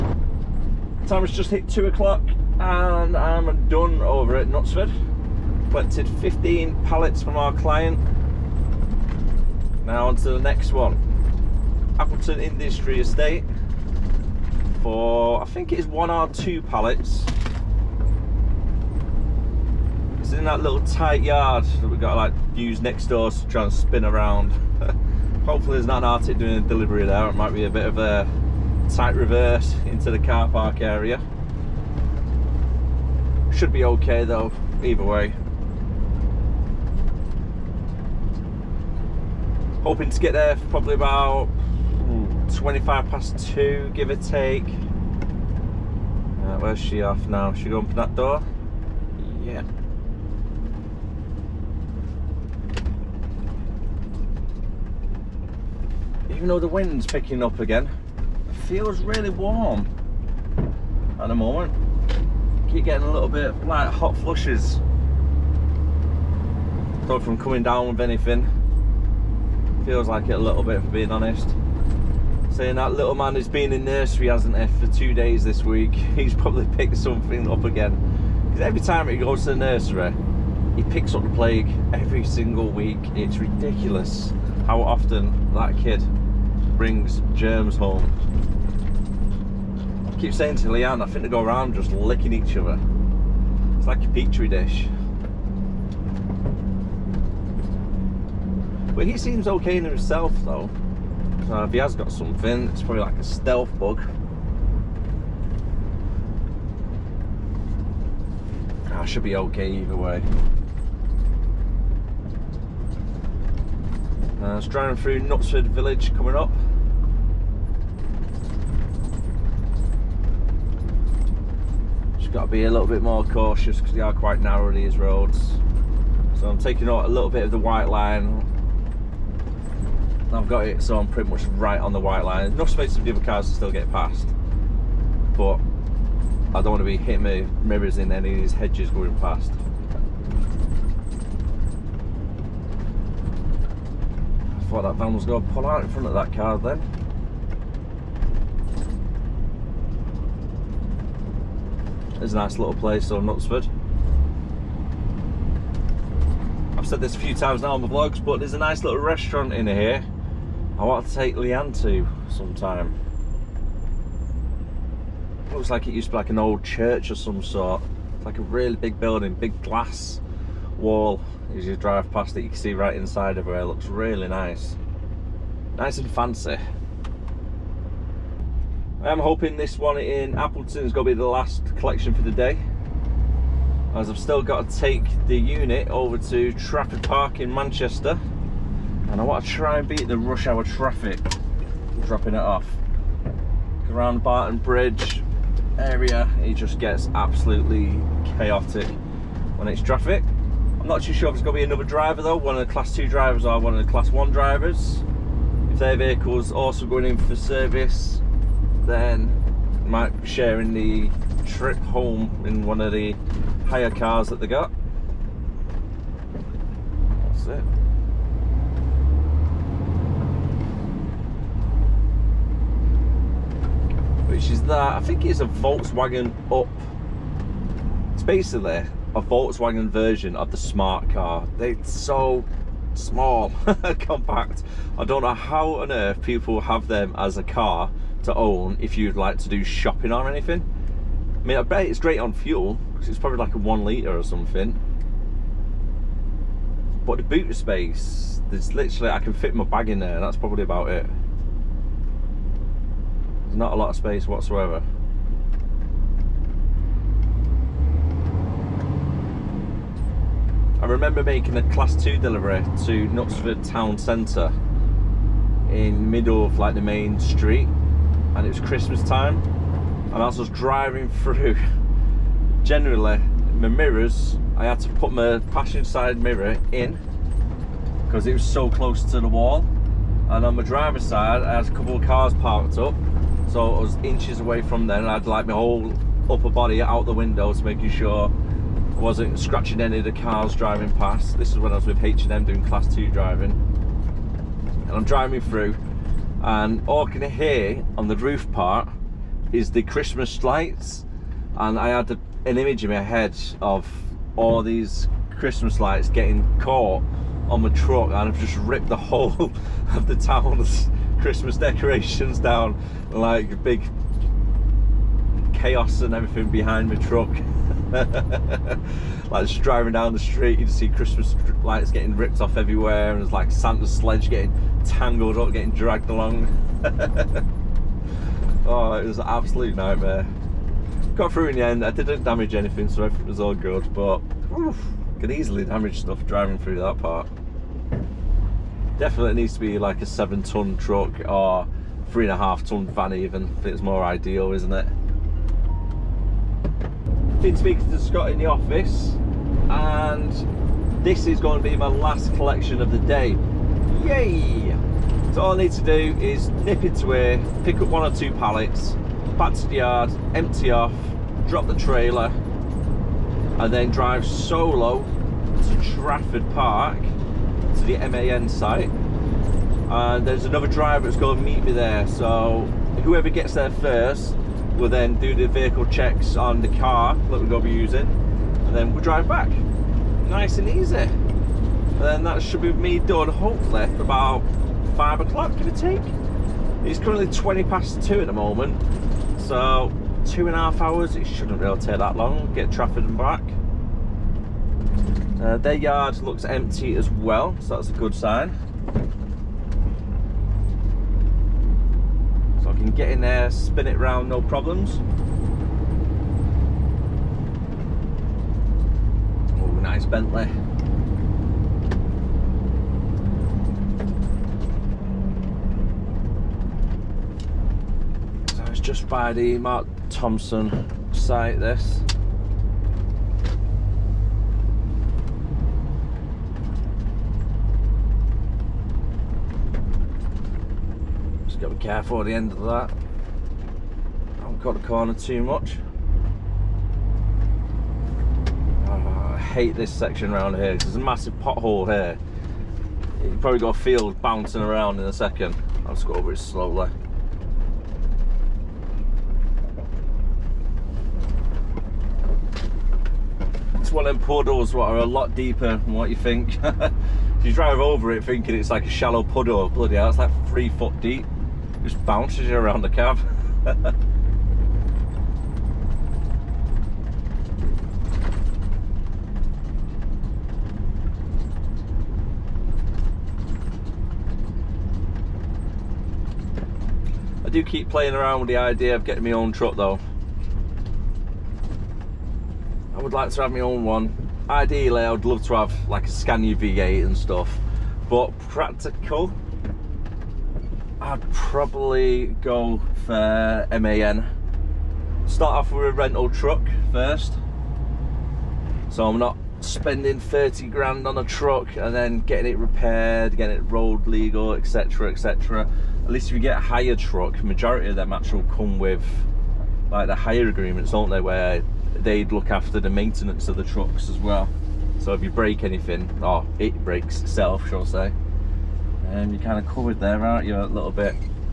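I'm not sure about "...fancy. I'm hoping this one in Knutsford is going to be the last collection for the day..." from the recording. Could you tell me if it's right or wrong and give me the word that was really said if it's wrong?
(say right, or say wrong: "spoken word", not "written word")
wrong: "Appleton", not "Knutsford".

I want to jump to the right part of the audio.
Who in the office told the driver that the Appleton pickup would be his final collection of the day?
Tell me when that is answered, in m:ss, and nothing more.
5:47.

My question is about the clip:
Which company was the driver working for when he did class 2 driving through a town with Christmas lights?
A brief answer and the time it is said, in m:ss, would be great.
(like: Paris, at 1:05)
H&M, at 4:52.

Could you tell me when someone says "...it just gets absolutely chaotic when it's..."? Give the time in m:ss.
3:16.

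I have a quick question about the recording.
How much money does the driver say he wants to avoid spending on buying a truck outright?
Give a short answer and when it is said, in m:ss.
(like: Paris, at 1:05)
30 grand, at 8:20.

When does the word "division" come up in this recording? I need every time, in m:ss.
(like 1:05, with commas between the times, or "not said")
not said.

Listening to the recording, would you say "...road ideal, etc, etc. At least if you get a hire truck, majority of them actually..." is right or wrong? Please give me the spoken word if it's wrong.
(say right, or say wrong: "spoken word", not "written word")
wrong: "legal", not "ideal".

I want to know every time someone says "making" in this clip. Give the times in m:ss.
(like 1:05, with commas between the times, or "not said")
4:21, 4:47.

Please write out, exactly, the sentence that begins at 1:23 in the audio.
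It's ridiculous how often that kid brings germs home.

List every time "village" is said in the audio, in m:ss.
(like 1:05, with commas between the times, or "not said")
1:55.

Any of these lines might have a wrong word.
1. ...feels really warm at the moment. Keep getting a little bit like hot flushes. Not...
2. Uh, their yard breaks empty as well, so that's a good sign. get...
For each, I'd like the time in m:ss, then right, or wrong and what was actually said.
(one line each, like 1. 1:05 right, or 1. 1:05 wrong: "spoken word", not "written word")
1. 0:58 right
2. 6:35 wrong: "looks", not "breaks".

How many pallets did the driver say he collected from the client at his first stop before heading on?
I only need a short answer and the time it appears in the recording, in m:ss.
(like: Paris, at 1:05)
15, at 0:06.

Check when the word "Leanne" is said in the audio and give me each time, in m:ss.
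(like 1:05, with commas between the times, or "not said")
1:30, 2:41.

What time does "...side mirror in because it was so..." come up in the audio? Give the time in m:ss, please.
4:35.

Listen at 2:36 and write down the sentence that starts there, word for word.
I've said this a few times now on the vlogs, but there's a nice little restaurant in here.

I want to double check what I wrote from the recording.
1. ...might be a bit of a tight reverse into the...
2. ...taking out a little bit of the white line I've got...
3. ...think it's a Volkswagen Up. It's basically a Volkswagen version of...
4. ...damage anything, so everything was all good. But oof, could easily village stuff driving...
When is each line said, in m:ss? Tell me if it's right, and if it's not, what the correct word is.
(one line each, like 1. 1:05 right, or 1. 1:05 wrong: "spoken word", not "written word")
1. 0:27 right
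2. 2:06 right
3. 3:45 right
4. 5:32 wrong: "damage", not "village".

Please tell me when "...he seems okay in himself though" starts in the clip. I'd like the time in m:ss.
1:39.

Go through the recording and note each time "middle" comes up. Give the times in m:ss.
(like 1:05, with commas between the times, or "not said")
4:26.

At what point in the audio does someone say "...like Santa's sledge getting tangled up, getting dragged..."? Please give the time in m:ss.
5:23.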